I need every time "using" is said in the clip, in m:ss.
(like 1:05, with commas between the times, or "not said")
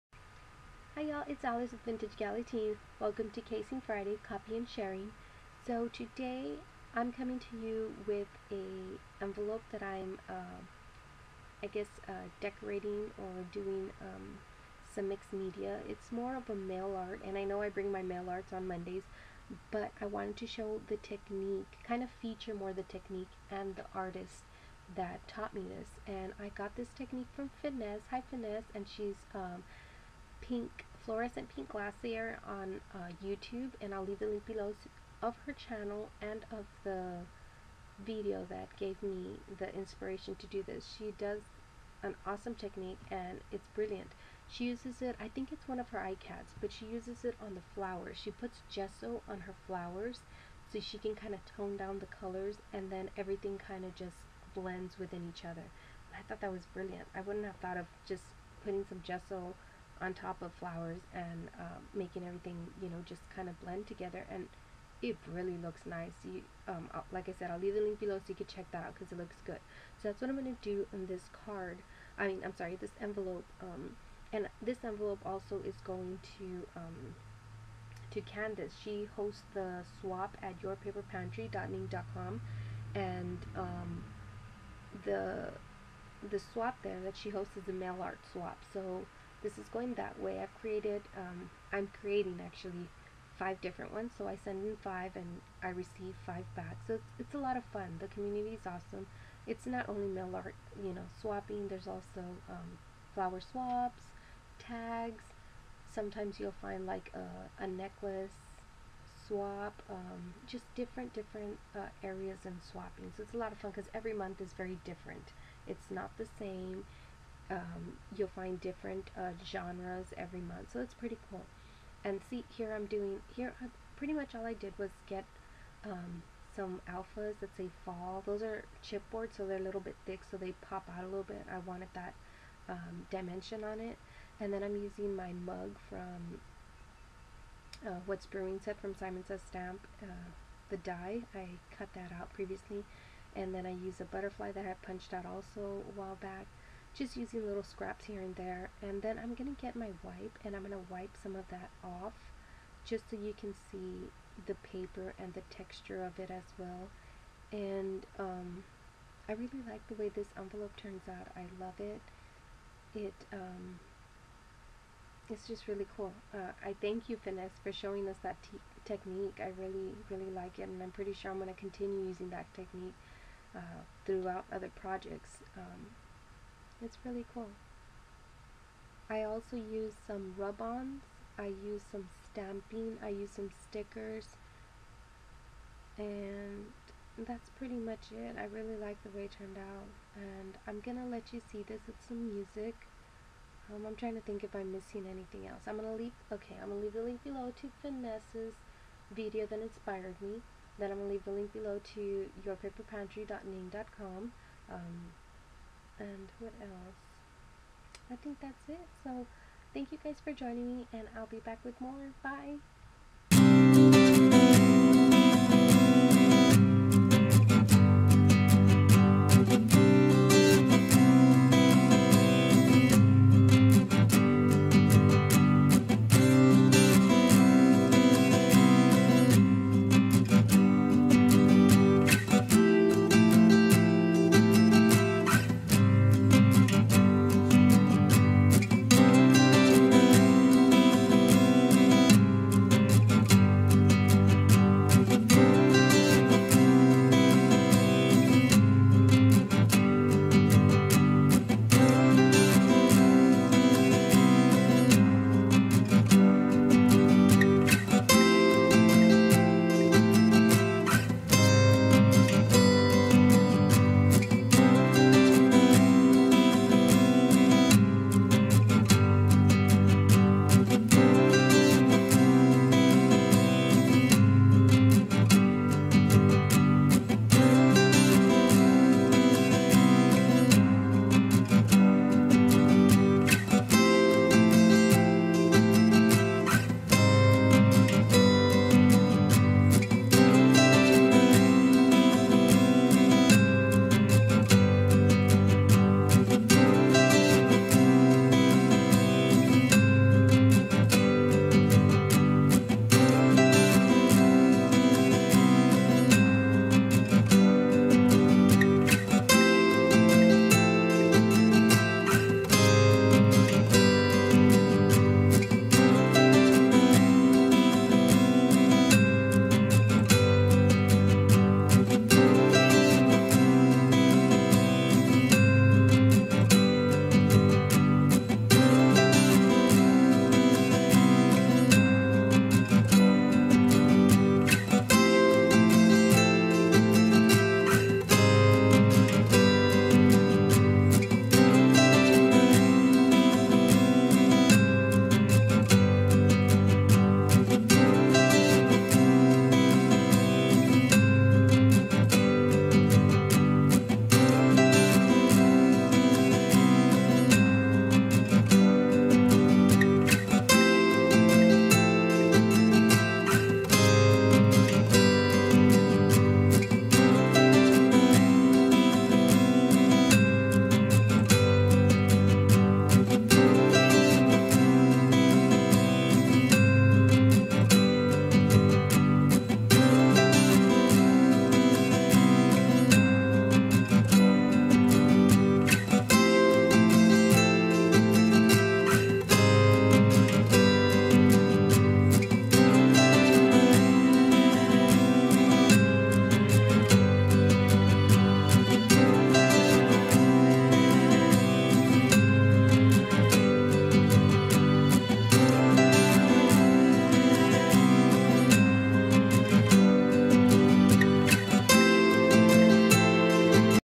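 2:14, 2:27, 2:52.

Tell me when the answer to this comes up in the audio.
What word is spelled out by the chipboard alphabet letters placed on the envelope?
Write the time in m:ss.
2:07.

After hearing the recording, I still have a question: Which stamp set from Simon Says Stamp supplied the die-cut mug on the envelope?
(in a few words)
What's Brewing.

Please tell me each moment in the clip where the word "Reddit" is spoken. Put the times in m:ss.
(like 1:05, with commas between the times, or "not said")
not said.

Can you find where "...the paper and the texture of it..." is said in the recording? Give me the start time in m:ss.
2:34.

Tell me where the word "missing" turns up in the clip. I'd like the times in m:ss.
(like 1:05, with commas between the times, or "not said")
3:14.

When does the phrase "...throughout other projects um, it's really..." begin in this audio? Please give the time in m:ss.
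2:54.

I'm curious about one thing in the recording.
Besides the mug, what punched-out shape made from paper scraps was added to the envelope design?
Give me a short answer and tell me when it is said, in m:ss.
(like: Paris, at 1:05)
Butterfly, at 2:24.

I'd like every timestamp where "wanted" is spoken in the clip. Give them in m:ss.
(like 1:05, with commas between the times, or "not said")
0:20, 2:11.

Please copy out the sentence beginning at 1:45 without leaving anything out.
Sometimes you'll find like a, a necklace swap, um, just different, different uh, areas and swapping.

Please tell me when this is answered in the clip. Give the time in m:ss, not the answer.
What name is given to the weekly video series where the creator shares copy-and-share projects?
0:03.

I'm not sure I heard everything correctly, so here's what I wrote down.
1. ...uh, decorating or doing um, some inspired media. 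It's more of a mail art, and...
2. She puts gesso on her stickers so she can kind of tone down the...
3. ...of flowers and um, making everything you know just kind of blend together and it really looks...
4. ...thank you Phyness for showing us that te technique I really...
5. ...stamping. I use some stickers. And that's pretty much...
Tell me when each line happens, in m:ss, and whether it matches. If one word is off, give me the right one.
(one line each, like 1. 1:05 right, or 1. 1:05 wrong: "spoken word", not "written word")
1. 0:12 wrong: "mixed", not "inspired"
2. 0:48 wrong: "flowers", not "stickers"
3. 1:00 right
4. 2:46 right
5. 3:02 right.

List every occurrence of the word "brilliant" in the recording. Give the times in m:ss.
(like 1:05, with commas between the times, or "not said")
0:43, 0:56.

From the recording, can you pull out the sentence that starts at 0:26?
And I got this technique from Phyness.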